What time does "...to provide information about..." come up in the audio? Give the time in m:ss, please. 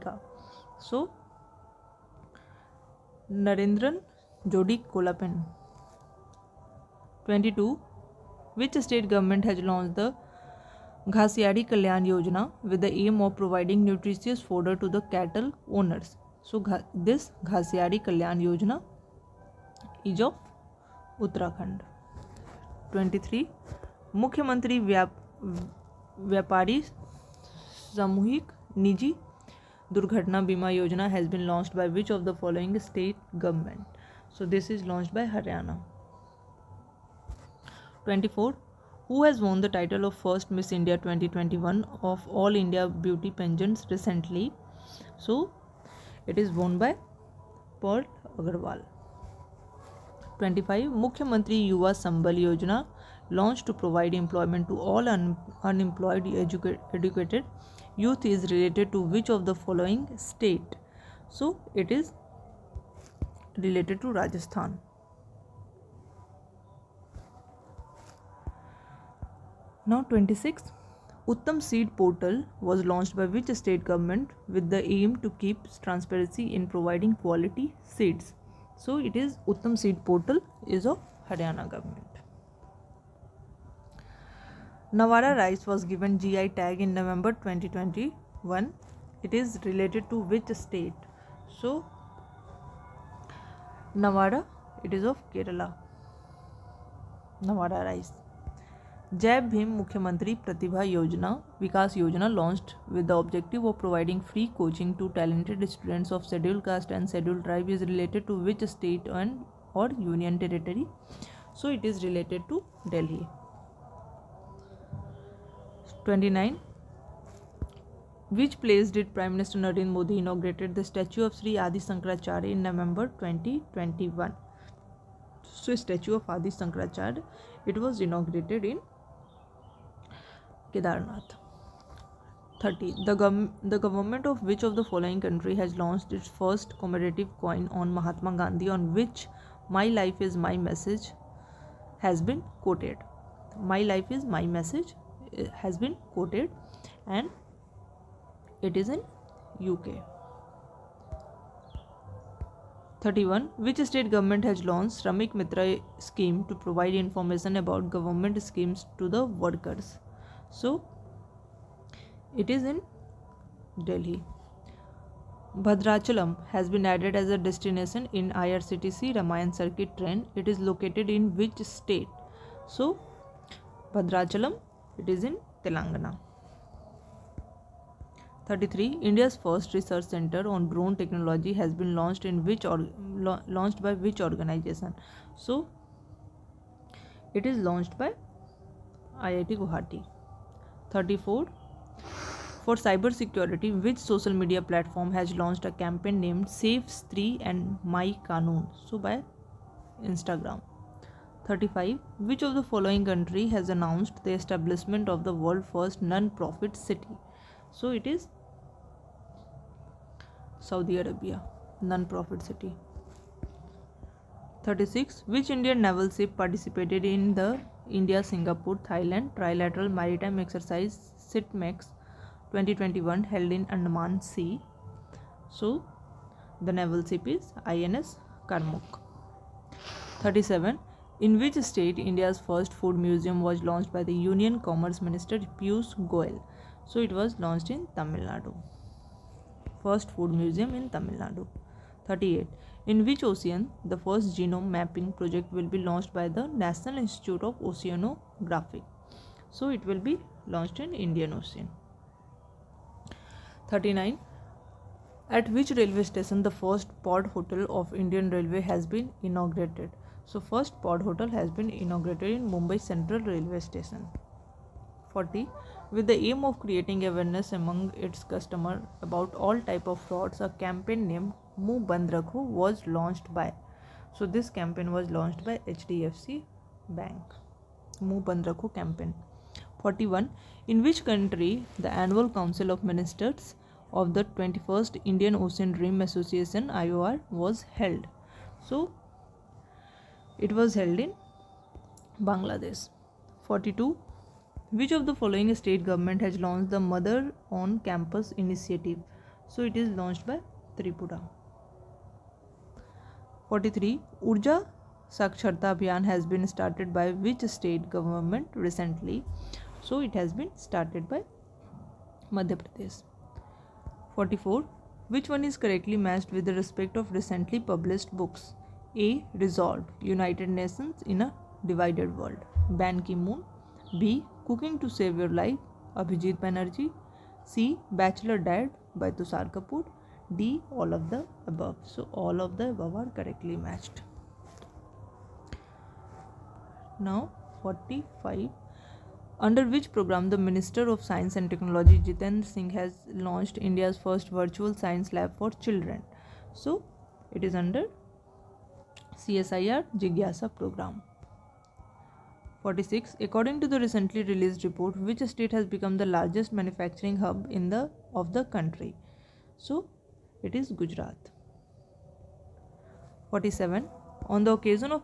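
2:36.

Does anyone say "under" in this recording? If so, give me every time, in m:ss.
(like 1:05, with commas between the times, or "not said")
5:39, 5:47.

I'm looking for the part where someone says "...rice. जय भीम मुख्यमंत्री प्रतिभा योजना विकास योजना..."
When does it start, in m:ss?
1:37.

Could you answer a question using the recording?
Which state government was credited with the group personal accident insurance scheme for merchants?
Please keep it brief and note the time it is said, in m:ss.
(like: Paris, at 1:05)
Haryana, at 0:35.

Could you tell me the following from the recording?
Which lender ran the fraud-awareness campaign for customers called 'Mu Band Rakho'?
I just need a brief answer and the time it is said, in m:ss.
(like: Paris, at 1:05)
HDFC Bank, at 4:35.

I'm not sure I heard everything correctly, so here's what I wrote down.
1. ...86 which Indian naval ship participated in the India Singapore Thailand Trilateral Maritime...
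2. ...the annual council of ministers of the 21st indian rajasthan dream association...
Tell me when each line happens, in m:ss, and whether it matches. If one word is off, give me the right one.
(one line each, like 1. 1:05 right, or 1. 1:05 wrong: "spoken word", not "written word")
1. 3:34 wrong: "36", not "86"
2. 4:41 wrong: "ocean", not "rajasthan".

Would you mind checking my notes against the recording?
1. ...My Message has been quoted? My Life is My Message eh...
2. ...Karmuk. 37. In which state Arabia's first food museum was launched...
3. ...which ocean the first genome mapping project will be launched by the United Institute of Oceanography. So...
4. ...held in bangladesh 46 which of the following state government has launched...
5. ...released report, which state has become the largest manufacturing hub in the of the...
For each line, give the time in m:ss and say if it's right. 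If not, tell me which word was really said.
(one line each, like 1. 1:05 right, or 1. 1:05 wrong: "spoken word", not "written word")
1. 2:20 right
2. 3:48 wrong: "India", not "Arabia"
3. 4:03 wrong: "National", not "United"
4. 4:50 wrong: "42", not "46"
5. 5:54 right.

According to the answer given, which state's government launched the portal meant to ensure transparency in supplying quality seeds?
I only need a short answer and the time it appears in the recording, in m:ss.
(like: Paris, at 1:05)
Haryana, at 1:21.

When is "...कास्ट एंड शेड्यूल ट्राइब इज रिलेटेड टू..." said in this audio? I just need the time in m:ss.
1:46.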